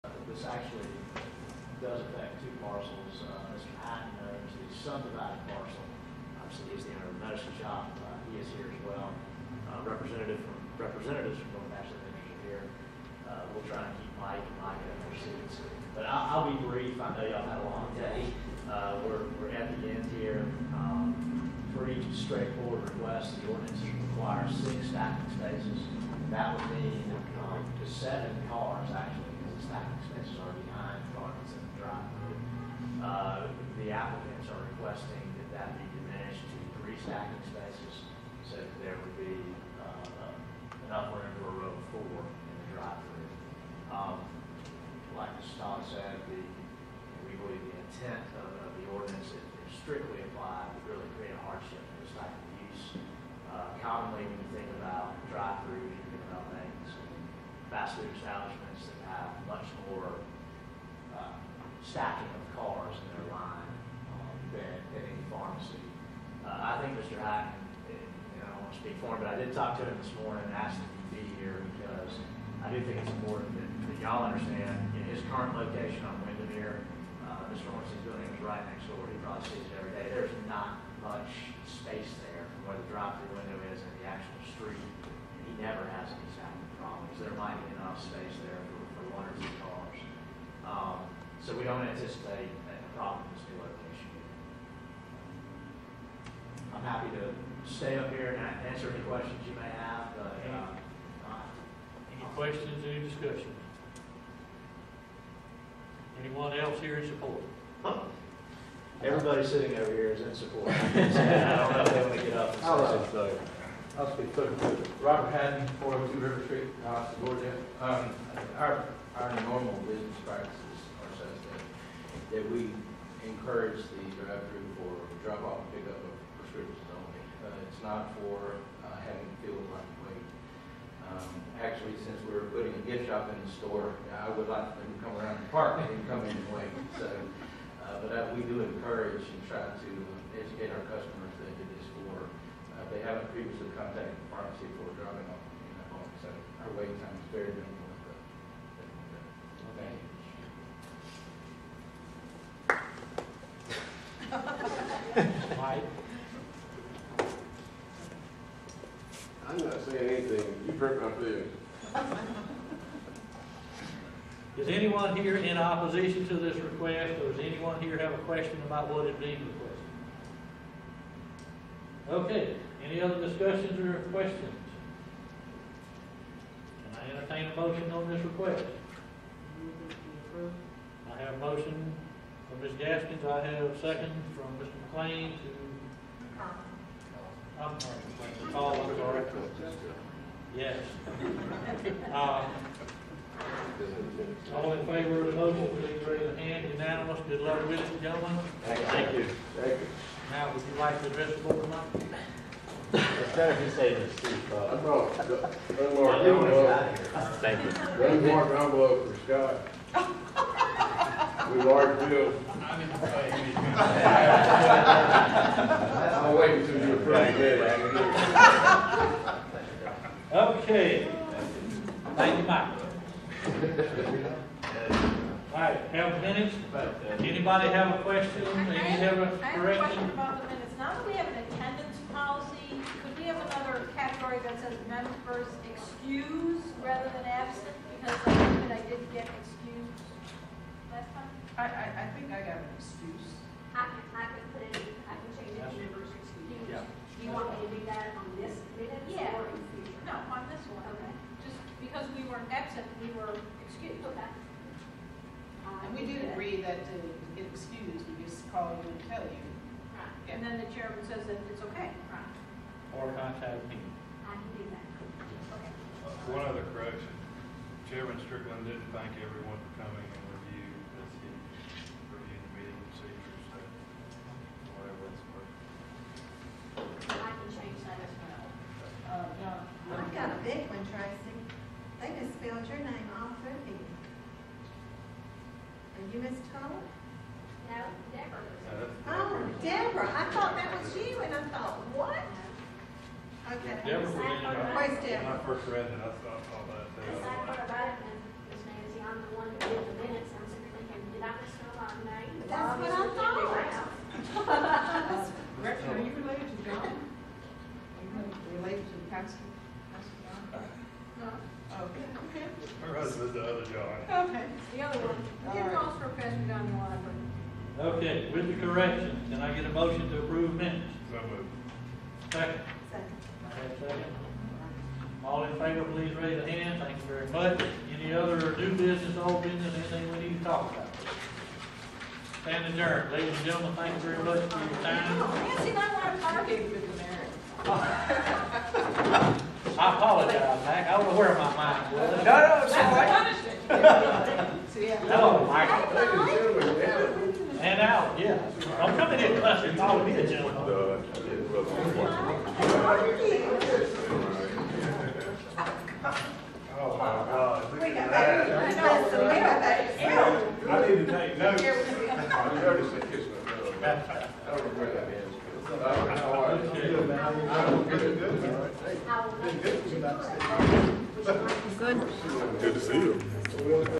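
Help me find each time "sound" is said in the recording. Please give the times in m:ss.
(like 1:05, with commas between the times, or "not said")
1:26.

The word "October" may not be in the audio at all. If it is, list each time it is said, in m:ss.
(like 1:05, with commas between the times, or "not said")
not said.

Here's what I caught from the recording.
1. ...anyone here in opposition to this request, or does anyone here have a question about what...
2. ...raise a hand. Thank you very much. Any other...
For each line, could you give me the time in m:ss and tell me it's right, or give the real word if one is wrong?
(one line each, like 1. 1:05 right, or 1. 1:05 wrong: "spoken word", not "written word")
1. 2:44 right
2. 5:26 right.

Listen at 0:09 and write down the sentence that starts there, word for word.
Uh, representative from, representatives from both Ashland Ventures are here.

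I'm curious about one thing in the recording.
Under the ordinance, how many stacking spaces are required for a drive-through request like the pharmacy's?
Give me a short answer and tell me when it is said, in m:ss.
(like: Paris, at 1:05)
6, at 0:24.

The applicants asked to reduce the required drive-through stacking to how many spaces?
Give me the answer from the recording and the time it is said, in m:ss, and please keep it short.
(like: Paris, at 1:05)
3, at 0:36.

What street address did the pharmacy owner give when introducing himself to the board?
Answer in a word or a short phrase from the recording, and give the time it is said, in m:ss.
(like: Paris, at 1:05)
402 River Street, at 1:55.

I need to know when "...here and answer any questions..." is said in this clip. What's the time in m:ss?
1:38.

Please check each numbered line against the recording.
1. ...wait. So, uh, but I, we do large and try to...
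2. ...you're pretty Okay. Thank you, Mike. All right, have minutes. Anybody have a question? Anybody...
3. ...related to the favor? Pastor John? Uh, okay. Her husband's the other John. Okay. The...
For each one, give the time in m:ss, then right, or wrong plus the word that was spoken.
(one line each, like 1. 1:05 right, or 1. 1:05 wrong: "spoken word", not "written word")
1. 2:16 wrong: "encourage", not "large"
2. 3:36 right
3. 5:08 wrong: "pastor", not "favor".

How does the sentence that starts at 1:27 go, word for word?
There might be enough space there for hundreds of cars.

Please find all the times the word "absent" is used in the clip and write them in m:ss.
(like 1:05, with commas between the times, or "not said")
3:57, 4:12.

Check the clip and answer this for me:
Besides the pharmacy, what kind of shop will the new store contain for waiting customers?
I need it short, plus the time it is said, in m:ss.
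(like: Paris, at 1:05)
gift shop, at 2:12.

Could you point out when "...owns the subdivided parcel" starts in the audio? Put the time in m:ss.
0:04.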